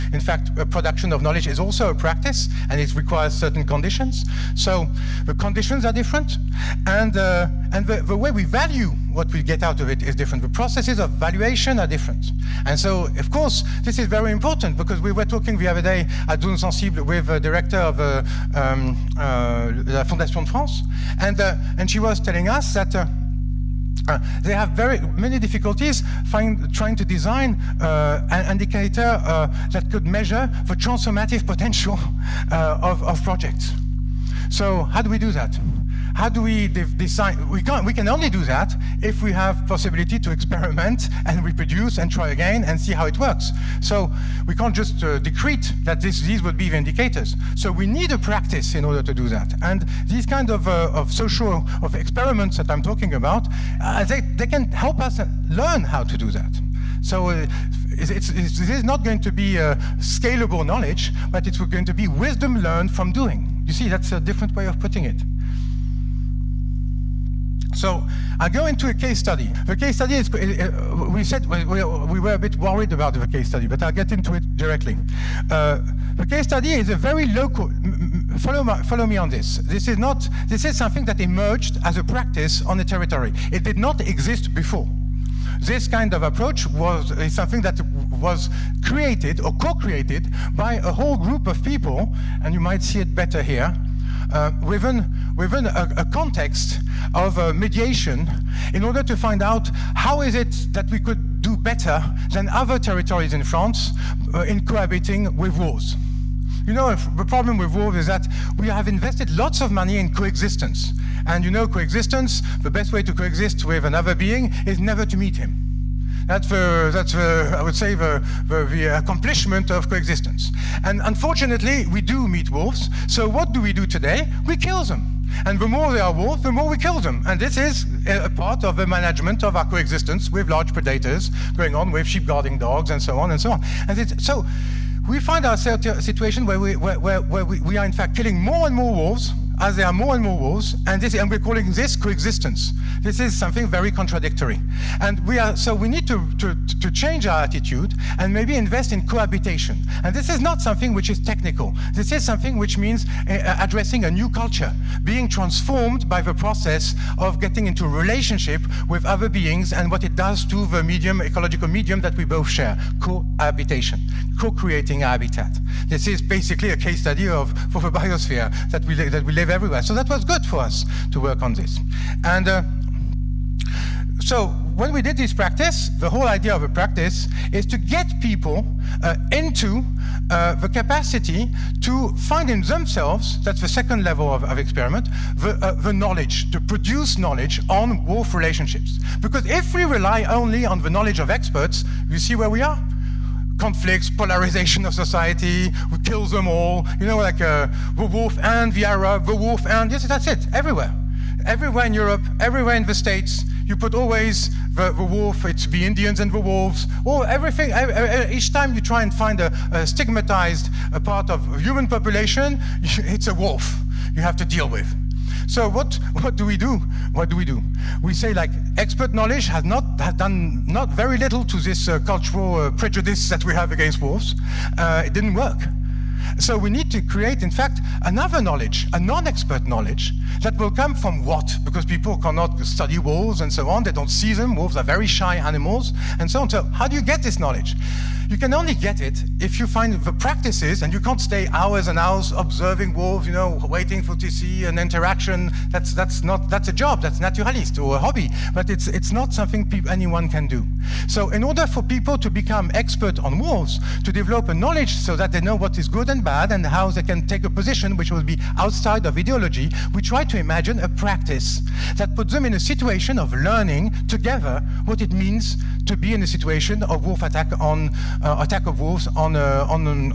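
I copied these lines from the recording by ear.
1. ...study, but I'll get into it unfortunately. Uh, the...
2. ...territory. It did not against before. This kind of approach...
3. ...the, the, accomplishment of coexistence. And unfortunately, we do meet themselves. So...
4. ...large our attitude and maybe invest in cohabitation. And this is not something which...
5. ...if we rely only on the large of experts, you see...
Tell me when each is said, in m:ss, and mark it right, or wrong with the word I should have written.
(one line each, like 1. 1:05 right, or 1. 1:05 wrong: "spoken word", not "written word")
1. 1:13 wrong: "directly", not "unfortunately"
2. 1:22 wrong: "exist", not "against"
3. 1:58 wrong: "wolves", not "themselves"
4. 2:26 wrong: "change", not "large"
5. 3:09 wrong: "knowledge", not "large".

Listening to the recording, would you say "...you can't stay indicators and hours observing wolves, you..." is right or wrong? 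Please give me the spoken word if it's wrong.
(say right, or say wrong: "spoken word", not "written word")
wrong: "hours", not "indicators".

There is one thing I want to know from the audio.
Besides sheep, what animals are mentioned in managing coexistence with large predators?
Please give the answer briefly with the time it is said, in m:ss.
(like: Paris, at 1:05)
Sheep guarding dogs, at 2:12.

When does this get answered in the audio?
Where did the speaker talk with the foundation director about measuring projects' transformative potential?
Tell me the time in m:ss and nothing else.
0:16.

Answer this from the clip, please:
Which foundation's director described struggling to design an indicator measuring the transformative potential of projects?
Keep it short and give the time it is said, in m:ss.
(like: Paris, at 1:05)
La Fondation de France, at 0:19.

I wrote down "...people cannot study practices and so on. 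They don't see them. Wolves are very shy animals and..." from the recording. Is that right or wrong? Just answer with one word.
wrong.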